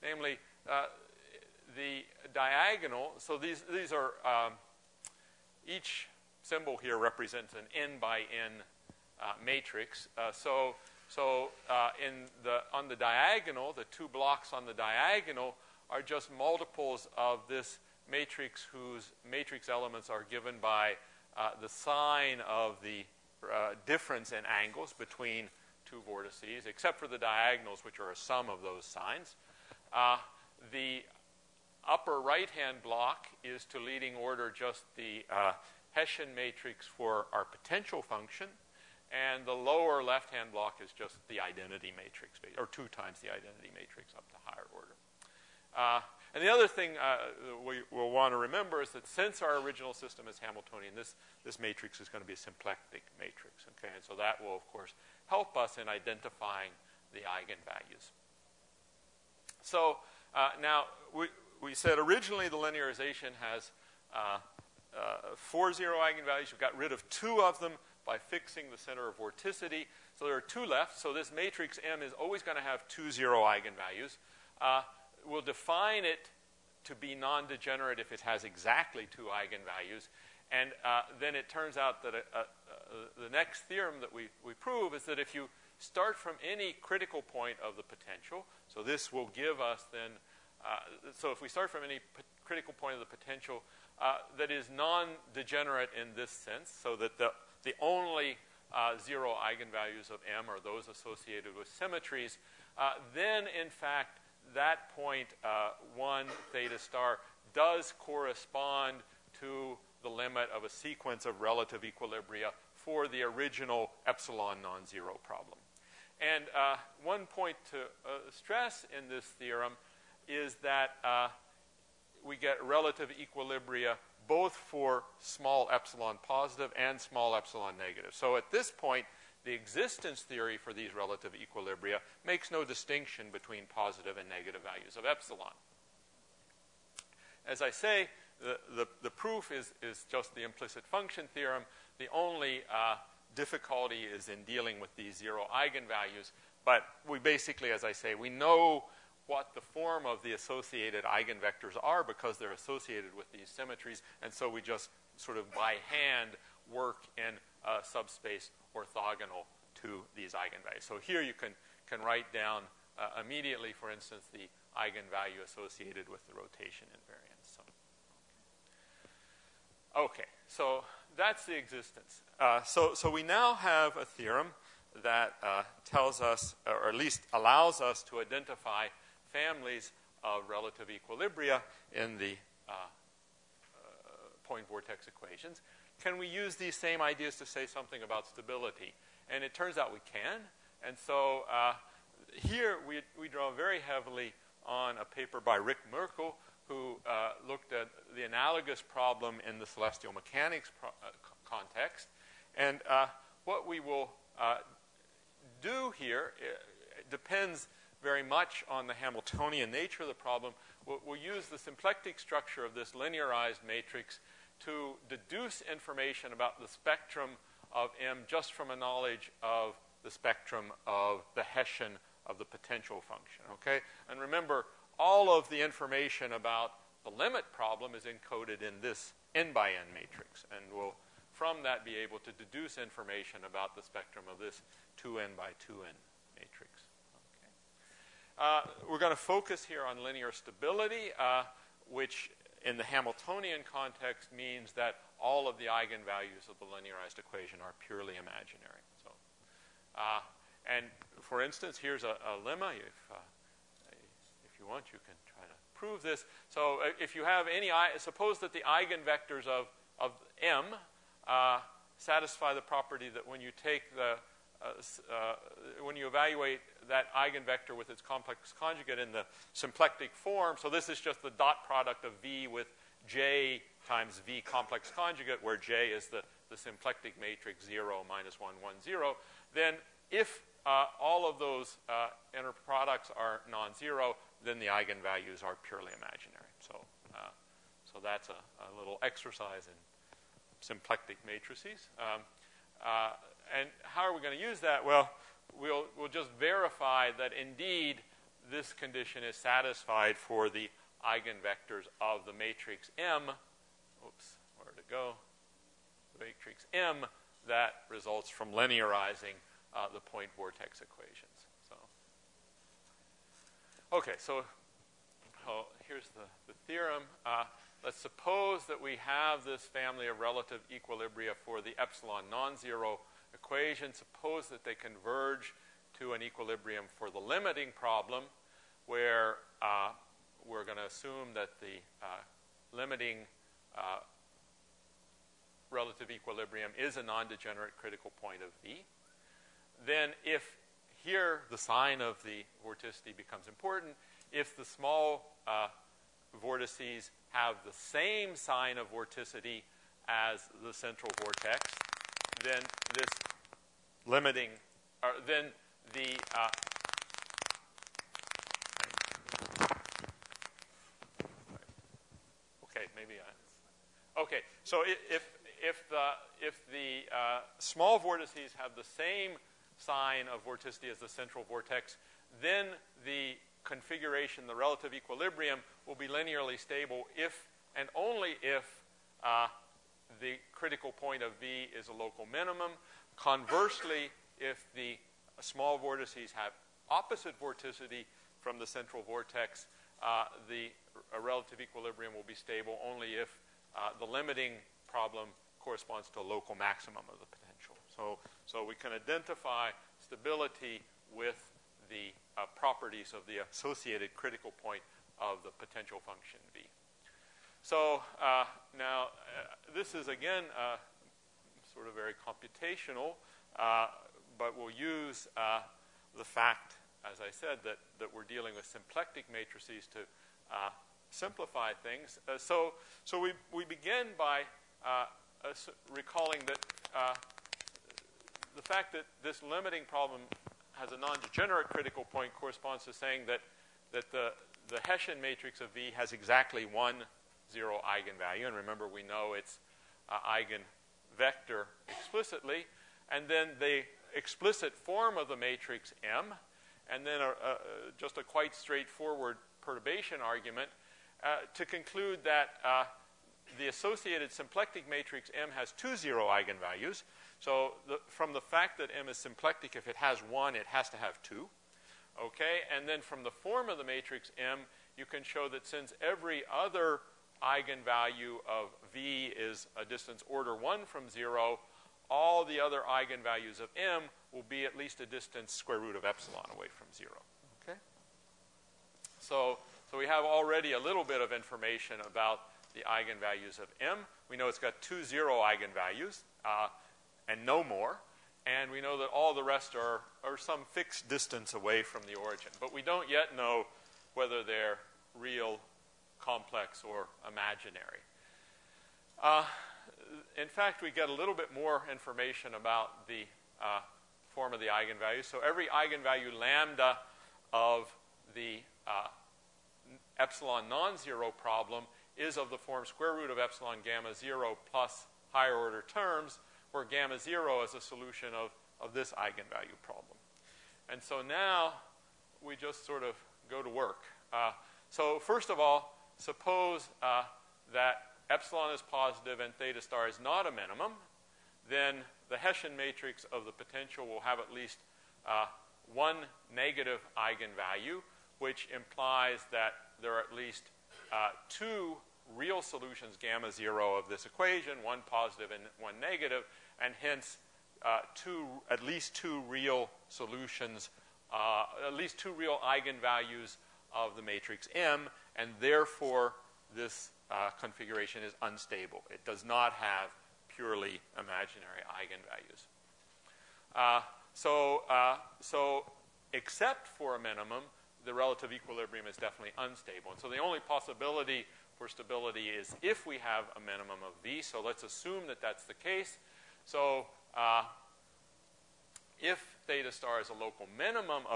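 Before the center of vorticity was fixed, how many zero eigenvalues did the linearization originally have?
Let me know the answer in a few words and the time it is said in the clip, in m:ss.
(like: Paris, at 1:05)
4, at 1:05.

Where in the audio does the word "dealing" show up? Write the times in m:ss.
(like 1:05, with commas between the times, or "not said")
2:24, 6:58.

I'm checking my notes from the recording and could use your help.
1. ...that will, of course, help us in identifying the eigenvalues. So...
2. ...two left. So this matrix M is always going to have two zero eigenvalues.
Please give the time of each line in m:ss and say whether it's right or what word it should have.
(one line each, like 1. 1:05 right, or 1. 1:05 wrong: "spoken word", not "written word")
1. 0:54 right
2. 1:10 right.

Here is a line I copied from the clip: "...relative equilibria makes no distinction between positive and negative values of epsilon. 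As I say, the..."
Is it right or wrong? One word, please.
right.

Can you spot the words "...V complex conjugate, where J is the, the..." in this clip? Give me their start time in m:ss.
4:34.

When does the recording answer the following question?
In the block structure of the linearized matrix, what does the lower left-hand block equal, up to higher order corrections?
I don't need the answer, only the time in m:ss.
0:42.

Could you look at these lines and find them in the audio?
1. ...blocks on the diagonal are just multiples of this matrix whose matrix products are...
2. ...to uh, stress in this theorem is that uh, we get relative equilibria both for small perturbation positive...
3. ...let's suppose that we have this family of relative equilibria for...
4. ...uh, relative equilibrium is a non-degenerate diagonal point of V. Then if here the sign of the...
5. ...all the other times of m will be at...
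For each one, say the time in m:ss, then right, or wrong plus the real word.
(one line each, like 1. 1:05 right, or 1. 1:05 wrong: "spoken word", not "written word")
1. 0:14 wrong: "elements", not "products"
2. 1:57 wrong: "epsilon", not "perturbation"
3. 5:17 right
4. 5:33 wrong: "critical", not "diagonal"
5. 7:52 wrong: "eigenvalues", not "times".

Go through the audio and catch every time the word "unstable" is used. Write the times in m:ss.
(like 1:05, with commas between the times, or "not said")
9:18, 9:29.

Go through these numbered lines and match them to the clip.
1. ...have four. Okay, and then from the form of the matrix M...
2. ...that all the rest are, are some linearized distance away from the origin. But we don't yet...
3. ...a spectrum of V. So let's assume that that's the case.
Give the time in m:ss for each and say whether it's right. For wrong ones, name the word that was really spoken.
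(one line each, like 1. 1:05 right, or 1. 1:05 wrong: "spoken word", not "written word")
1. 7:40 wrong: "two", not "four"
2. 8:08 wrong: "fixed", not "linearized"
3. 9:33 wrong: "minimum", not "spectrum".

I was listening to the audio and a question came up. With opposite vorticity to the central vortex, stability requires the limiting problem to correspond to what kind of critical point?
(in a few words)
Local maximum.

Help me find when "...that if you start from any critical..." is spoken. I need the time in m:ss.
1:25.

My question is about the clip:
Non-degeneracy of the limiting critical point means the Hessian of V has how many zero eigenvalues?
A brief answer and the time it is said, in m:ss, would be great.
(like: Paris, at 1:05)
1, at 7:16.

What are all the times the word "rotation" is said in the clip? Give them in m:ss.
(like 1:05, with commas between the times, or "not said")
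2:46.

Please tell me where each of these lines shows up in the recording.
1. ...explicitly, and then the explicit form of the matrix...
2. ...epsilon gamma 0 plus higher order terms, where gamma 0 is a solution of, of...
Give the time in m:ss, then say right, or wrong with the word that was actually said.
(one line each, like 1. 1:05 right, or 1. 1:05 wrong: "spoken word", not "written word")
1. 7:21 right
2. 8:33 right.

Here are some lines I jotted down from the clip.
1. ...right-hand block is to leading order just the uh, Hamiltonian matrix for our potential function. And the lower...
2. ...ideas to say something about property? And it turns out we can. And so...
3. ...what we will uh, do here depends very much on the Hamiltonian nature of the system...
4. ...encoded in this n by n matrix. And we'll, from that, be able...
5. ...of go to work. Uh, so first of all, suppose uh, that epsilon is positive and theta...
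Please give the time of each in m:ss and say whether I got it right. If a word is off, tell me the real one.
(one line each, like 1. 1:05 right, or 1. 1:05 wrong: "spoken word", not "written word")
1. 0:32 wrong: "Hessian", not "Hamiltonian"
2. 3:07 wrong: "stability", not "property"
3. 3:23 wrong: "problem", not "system"
4. 3:48 right
5. 8:43 right.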